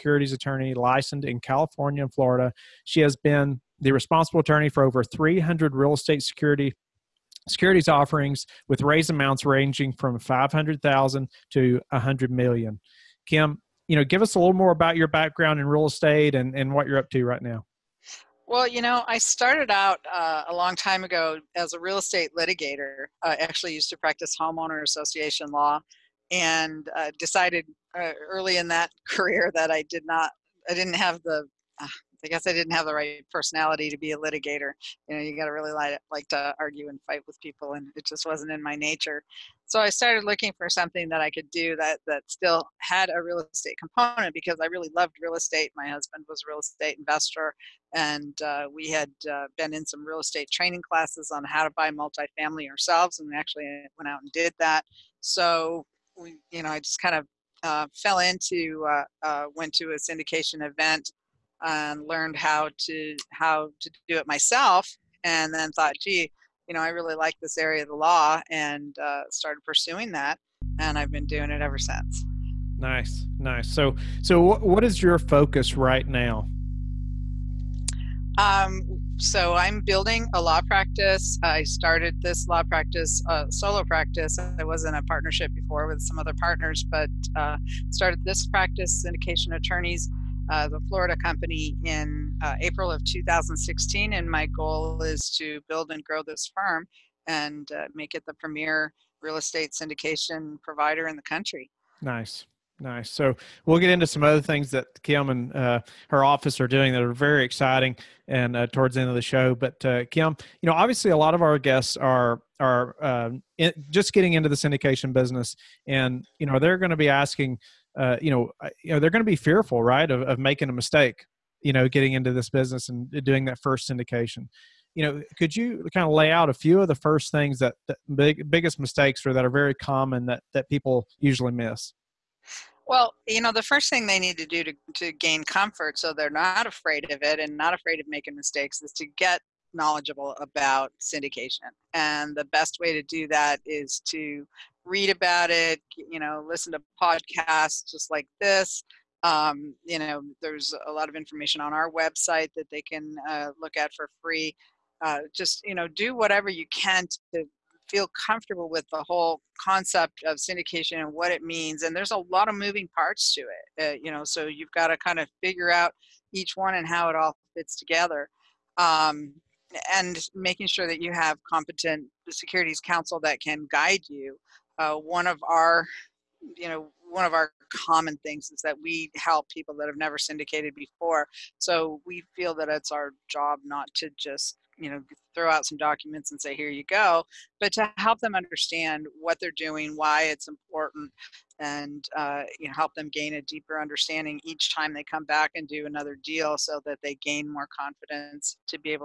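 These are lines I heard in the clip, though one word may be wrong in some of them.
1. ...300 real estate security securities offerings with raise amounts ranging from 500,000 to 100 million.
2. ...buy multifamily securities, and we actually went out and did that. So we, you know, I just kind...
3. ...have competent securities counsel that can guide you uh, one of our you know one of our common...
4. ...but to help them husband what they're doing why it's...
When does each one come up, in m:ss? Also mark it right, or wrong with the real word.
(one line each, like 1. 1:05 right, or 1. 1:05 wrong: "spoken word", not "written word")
1. 0:05 right
2. 0:51 wrong: "ourselves", not "securities"
3. 2:51 right
4. 3:07 wrong: "understand", not "husband".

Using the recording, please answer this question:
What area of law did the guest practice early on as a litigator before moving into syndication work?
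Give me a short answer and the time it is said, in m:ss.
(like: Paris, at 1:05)
homeowner association law, at 0:24.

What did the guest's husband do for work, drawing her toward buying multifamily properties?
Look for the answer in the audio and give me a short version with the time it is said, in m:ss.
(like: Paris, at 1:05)
real estate investor, at 0:46.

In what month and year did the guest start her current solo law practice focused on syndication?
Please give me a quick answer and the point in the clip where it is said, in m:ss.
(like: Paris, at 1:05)
April 2016, at 1:32.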